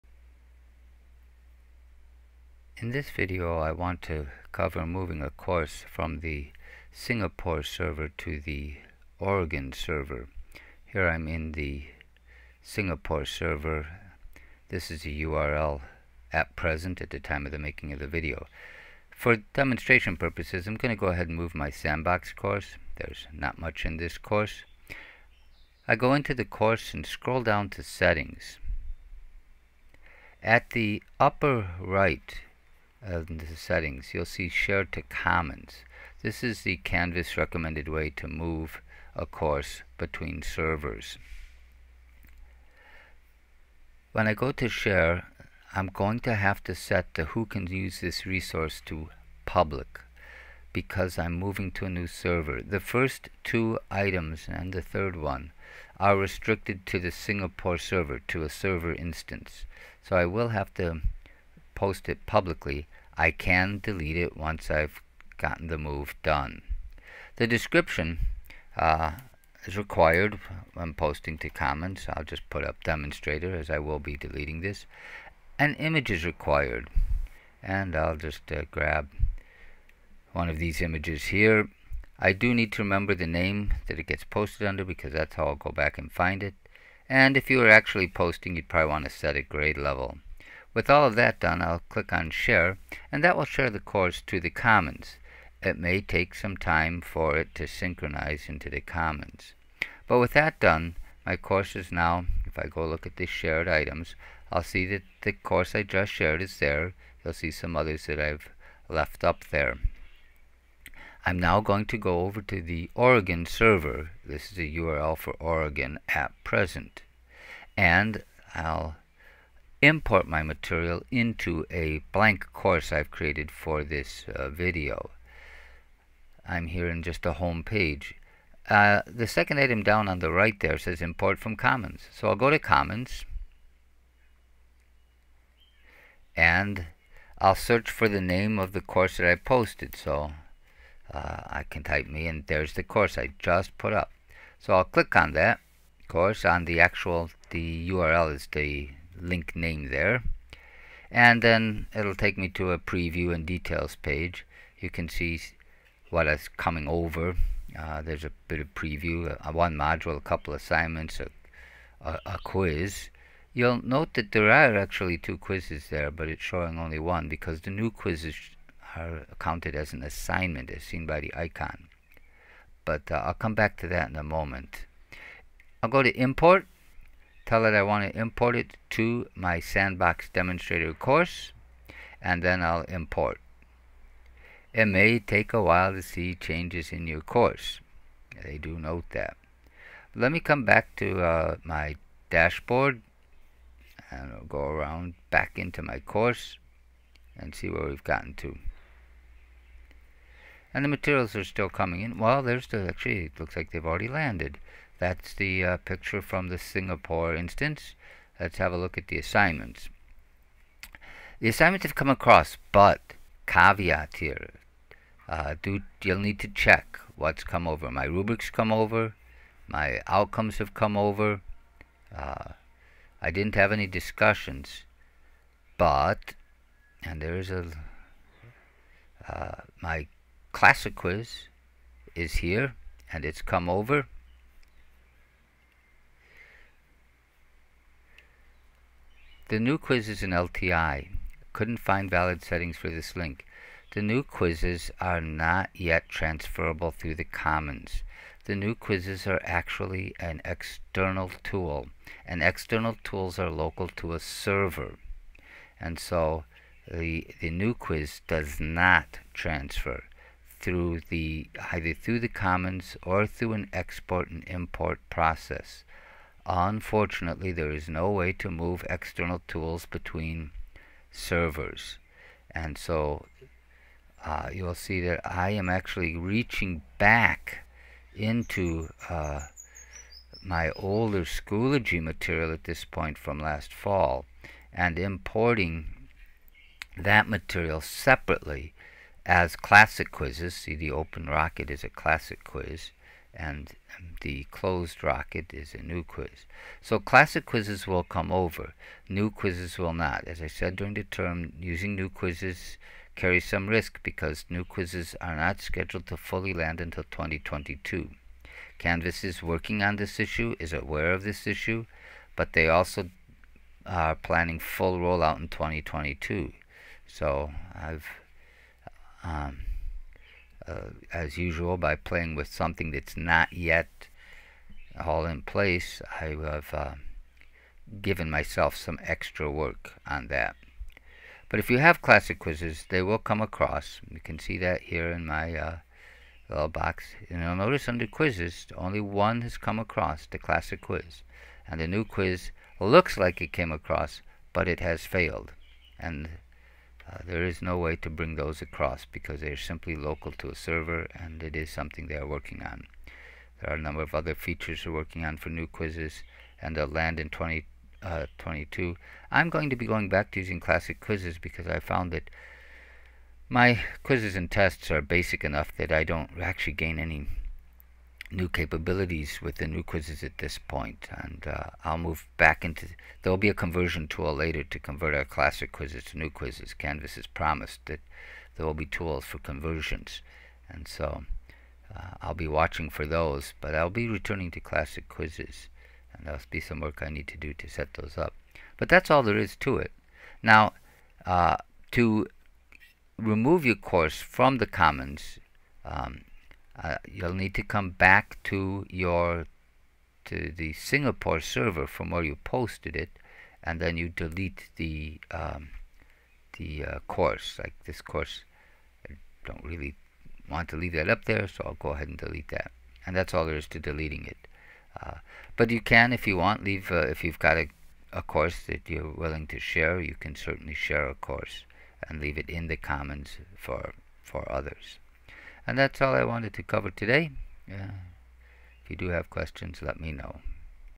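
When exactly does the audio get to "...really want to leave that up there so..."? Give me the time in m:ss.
6:49.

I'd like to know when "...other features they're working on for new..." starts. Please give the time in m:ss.
5:54.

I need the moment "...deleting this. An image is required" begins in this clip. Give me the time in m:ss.
1:14.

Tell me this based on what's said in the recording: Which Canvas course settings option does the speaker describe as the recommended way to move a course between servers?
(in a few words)
Share to Commons.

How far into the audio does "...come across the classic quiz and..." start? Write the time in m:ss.
5:39.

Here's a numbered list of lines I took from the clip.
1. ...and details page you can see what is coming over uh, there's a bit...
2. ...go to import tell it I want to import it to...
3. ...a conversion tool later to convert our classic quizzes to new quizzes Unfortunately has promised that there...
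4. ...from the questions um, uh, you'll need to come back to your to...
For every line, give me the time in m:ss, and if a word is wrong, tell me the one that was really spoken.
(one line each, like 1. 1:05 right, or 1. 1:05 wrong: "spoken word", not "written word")
1. 2:33 right
2. 2:55 right
3. 6:13 wrong: "Canvas", not "Unfortunately"
4. 6:34 wrong: "commons", not "questions".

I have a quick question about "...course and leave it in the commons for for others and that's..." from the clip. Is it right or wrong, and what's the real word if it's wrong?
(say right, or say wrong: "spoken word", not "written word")
right.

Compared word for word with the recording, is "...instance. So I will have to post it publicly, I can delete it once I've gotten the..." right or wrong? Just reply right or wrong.
right.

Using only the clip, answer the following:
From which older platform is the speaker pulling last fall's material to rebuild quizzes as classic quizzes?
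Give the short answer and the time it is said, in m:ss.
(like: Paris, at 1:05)
Schoology, at 4:41.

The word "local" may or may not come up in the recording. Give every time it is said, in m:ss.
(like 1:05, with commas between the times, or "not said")
4:13, 5:49.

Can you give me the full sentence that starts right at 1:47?
You'll see some others that I've left up there.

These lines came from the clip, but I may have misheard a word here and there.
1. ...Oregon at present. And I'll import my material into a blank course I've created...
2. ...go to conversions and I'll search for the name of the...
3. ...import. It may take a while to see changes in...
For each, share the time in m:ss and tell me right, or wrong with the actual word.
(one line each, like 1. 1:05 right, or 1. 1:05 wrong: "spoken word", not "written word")
1. 1:55 right
2. 2:12 wrong: "commons", not "conversions"
3. 3:02 right.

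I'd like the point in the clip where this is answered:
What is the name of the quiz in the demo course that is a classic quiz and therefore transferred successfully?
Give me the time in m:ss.
4:50.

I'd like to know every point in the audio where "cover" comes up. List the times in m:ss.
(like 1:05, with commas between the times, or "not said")
0:04, 7:06.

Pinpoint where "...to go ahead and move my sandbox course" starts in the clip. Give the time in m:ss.
0:20.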